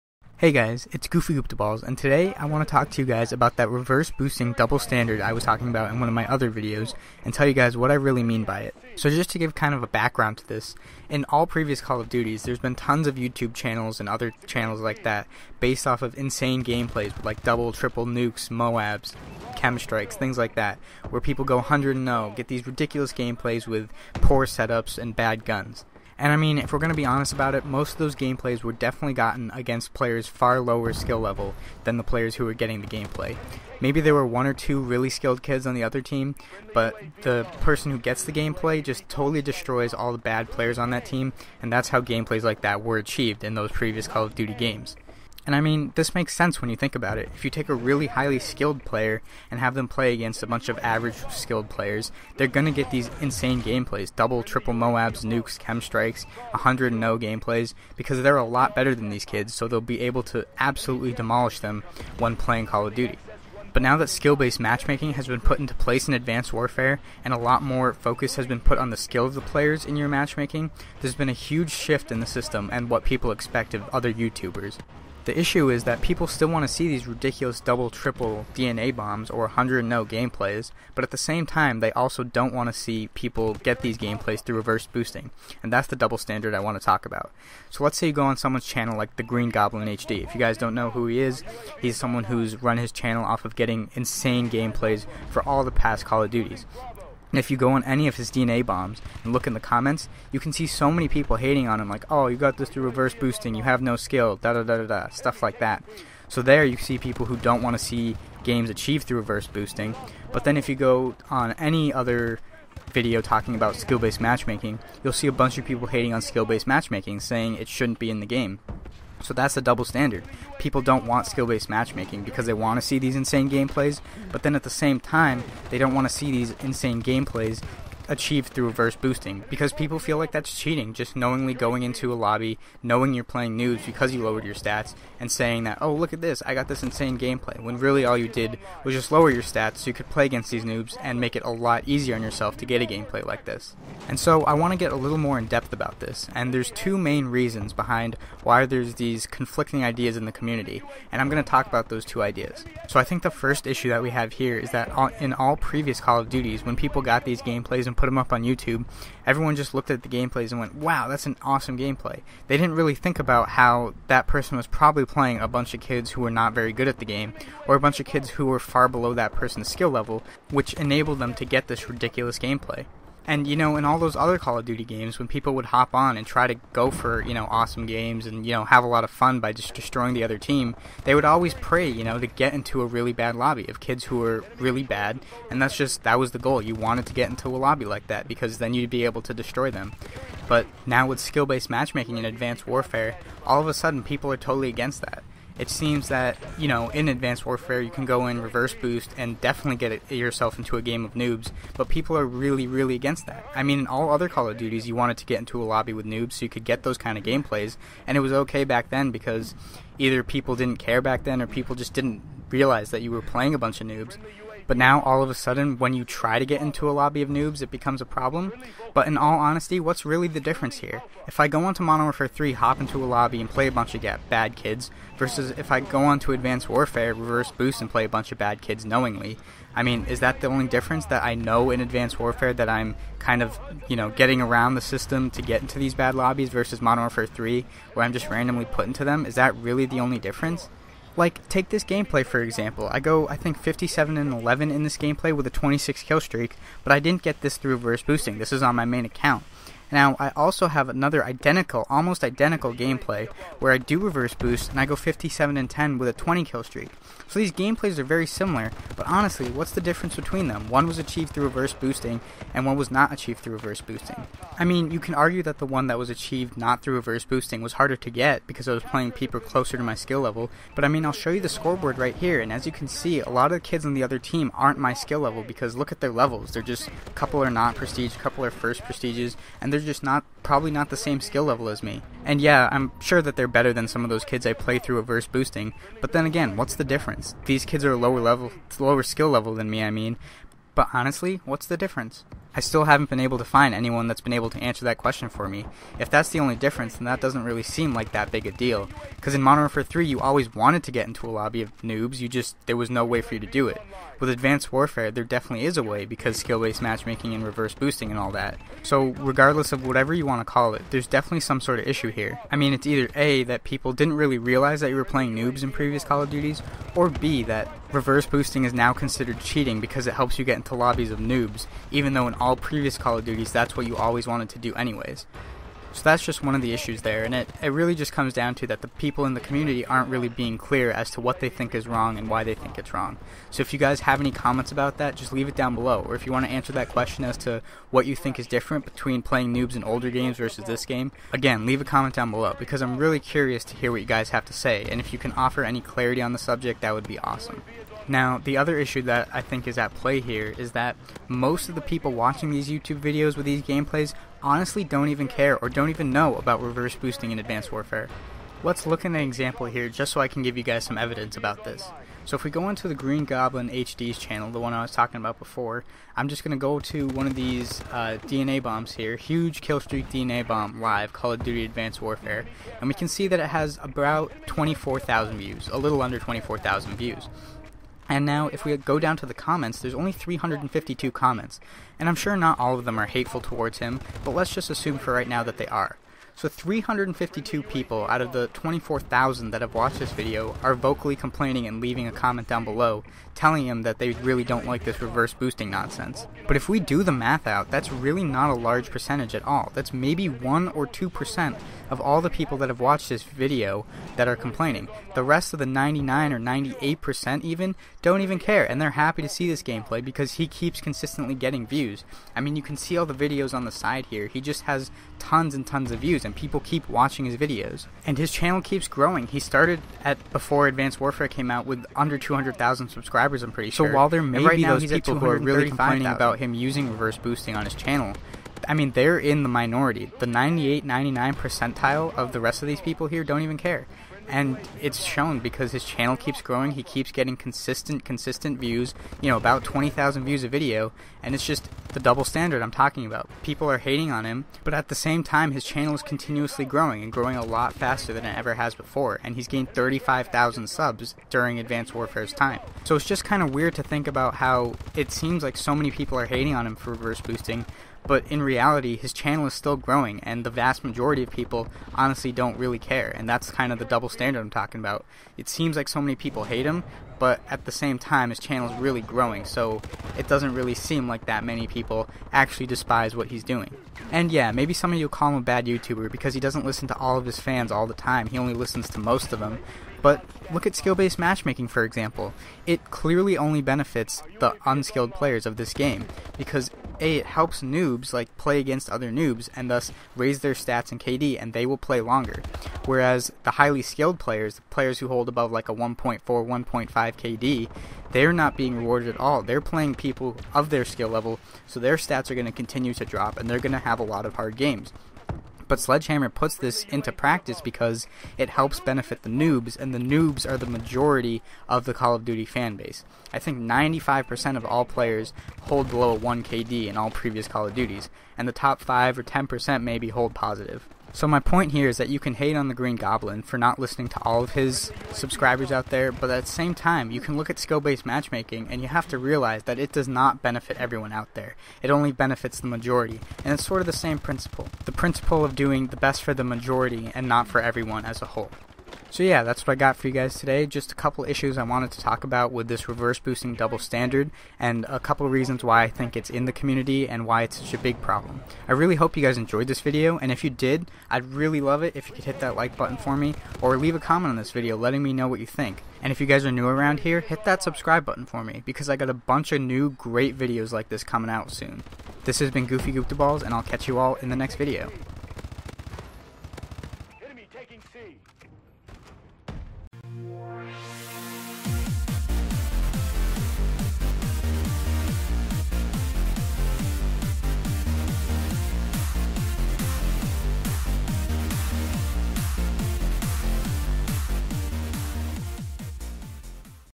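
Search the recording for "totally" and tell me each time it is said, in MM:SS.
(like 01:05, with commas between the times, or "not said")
00:39, 03:14.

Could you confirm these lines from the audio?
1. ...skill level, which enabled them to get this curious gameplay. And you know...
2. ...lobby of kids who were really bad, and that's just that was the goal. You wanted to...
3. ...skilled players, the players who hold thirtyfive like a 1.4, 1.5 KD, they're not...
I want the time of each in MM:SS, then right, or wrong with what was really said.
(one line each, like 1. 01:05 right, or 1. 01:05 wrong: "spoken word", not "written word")
1. 02:49 wrong: "ridiculous", not "curious"
2. 03:03 right
3. 08:13 wrong: "above", not "thirtyfive".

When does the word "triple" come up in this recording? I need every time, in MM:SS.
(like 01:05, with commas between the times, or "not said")
00:17, 00:54, 01:17.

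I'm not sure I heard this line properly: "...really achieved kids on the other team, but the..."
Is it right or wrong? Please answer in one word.
wrong.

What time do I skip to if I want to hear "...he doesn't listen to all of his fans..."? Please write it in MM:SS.
07:56.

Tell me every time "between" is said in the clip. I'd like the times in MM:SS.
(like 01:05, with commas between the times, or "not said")
04:20, 05:38.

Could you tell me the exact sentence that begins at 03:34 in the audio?
But now, all of a sudden, when you try to get into a lobby of noobs, it becomes a problem.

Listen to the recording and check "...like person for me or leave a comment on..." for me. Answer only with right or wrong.
wrong.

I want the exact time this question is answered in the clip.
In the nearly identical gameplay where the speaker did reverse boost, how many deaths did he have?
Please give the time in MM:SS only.
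04:14.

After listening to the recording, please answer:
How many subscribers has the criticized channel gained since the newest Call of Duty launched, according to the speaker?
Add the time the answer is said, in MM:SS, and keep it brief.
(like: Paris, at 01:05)
35,000, at 07:29.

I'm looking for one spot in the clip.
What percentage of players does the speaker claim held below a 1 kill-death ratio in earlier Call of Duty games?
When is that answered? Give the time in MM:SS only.
08:33.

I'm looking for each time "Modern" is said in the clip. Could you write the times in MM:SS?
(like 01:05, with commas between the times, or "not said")
03:41, 03:56, 04:59.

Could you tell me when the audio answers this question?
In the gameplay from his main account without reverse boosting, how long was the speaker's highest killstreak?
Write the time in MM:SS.
04:05.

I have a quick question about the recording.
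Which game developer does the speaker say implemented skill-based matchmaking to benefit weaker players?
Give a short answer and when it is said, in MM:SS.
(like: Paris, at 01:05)
Sledgehammer, at 08:25.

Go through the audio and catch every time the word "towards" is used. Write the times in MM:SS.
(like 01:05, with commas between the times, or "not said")
06:23.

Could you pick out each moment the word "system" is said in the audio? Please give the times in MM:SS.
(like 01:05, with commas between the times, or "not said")
01:12, 03:54.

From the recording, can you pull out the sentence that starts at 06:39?
That's maybe 1 or 2% of all the people that have watched this video that are complaining.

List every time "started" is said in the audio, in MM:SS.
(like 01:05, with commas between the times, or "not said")
06:59.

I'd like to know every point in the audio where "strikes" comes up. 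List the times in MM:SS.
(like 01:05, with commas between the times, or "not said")
00:19, 00:55.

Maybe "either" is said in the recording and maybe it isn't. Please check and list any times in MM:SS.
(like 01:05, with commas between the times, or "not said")
03:29, 05:12.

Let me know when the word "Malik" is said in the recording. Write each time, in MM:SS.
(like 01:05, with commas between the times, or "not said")
not said.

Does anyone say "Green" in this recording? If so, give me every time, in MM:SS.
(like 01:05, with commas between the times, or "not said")
01:29, 06:02, 08:42.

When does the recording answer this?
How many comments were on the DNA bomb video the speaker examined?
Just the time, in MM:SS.
06:20.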